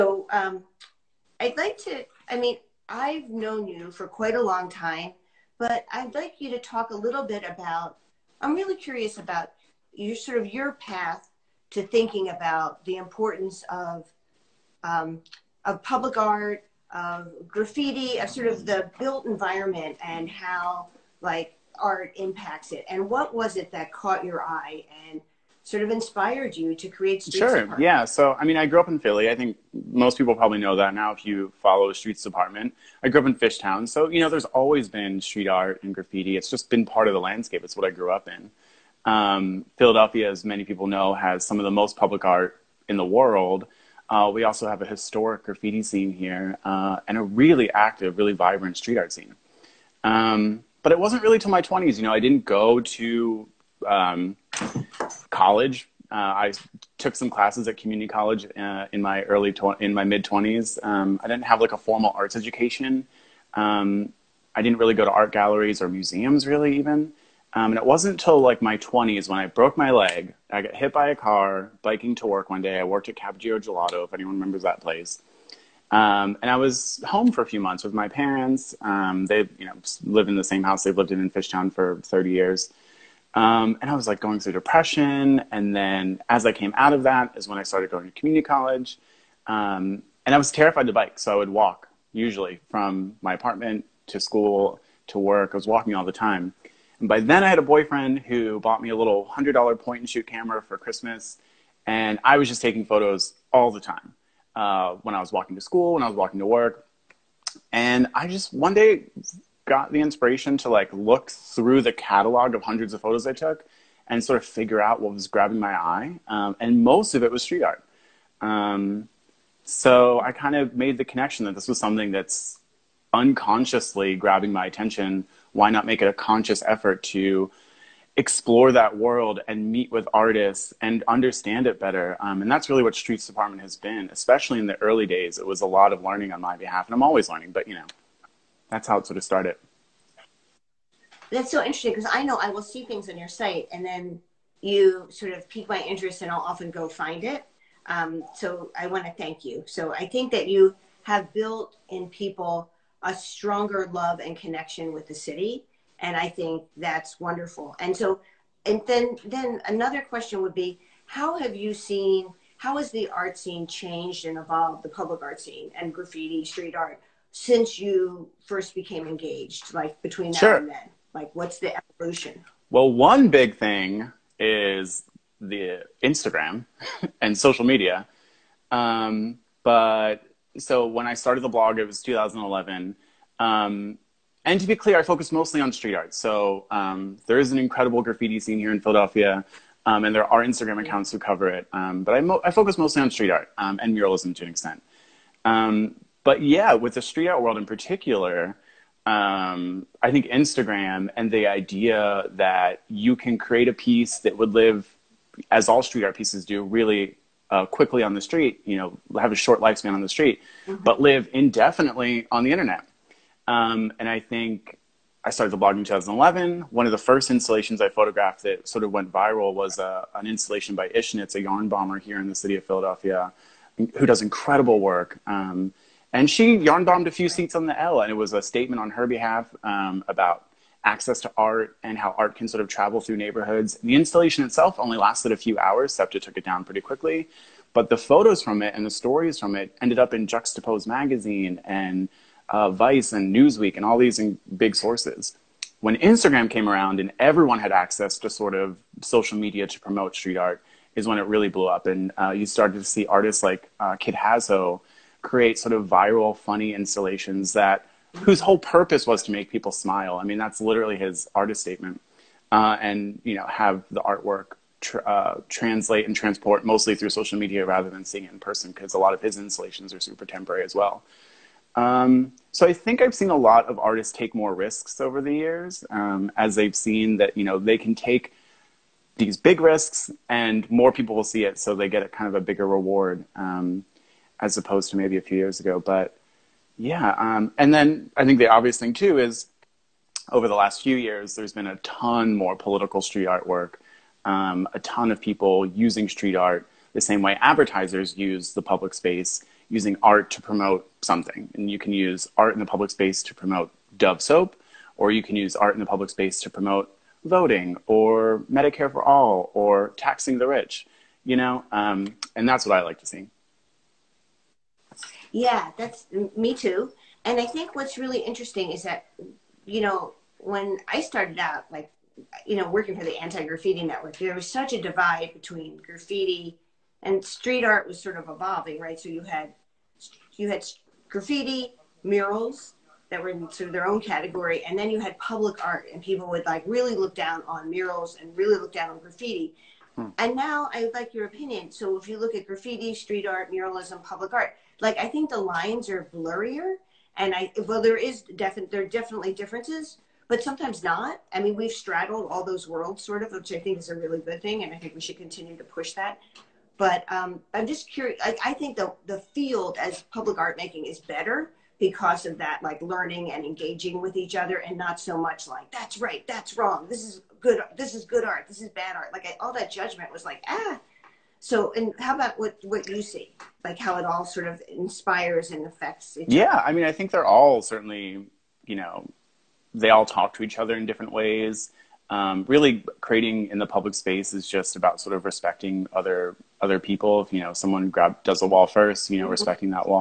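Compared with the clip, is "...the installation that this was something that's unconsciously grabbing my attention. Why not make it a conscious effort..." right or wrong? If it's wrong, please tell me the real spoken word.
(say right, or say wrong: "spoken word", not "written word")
wrong: "connection", not "installation".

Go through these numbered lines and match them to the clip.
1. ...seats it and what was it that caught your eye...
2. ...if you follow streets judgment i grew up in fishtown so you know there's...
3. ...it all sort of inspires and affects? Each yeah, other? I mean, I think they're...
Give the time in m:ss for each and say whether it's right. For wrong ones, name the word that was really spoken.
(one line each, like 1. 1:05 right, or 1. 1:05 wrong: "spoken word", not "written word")
1. 0:22 wrong: "impacts", not "seats"
2. 0:31 wrong: "department", not "judgment"
3. 6:13 right.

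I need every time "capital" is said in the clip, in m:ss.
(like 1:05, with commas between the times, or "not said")
not said.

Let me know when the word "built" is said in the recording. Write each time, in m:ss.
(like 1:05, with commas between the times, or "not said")
0:18, 2:31.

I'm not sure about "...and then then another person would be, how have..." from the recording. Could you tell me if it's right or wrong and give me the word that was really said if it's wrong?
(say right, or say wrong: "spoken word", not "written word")
wrong: "question", not "person".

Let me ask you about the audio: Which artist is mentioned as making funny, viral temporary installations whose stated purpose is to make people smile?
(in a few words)
Kid Hazo.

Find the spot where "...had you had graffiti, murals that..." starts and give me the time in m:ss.
5:29.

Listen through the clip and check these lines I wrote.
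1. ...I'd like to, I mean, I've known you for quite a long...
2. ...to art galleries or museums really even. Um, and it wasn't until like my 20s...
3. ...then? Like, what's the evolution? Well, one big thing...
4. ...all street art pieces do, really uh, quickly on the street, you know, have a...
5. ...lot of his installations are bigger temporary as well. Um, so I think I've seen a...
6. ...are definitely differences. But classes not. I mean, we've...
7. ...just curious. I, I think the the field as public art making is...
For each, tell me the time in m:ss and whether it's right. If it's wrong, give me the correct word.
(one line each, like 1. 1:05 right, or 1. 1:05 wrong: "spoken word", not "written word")
1. 0:01 right
2. 1:05 right
3. 2:50 right
4. 3:25 right
5. 4:28 wrong: "super", not "bigger"
6. 5:48 wrong: "sometimes", not "classes"
7. 5:57 right.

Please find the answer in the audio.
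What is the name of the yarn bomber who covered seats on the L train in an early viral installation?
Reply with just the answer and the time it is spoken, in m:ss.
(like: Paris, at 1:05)
Ishknits, at 3:40.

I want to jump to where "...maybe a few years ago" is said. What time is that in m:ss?
4:44.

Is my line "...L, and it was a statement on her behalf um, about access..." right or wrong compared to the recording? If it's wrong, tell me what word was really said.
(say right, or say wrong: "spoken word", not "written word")
right.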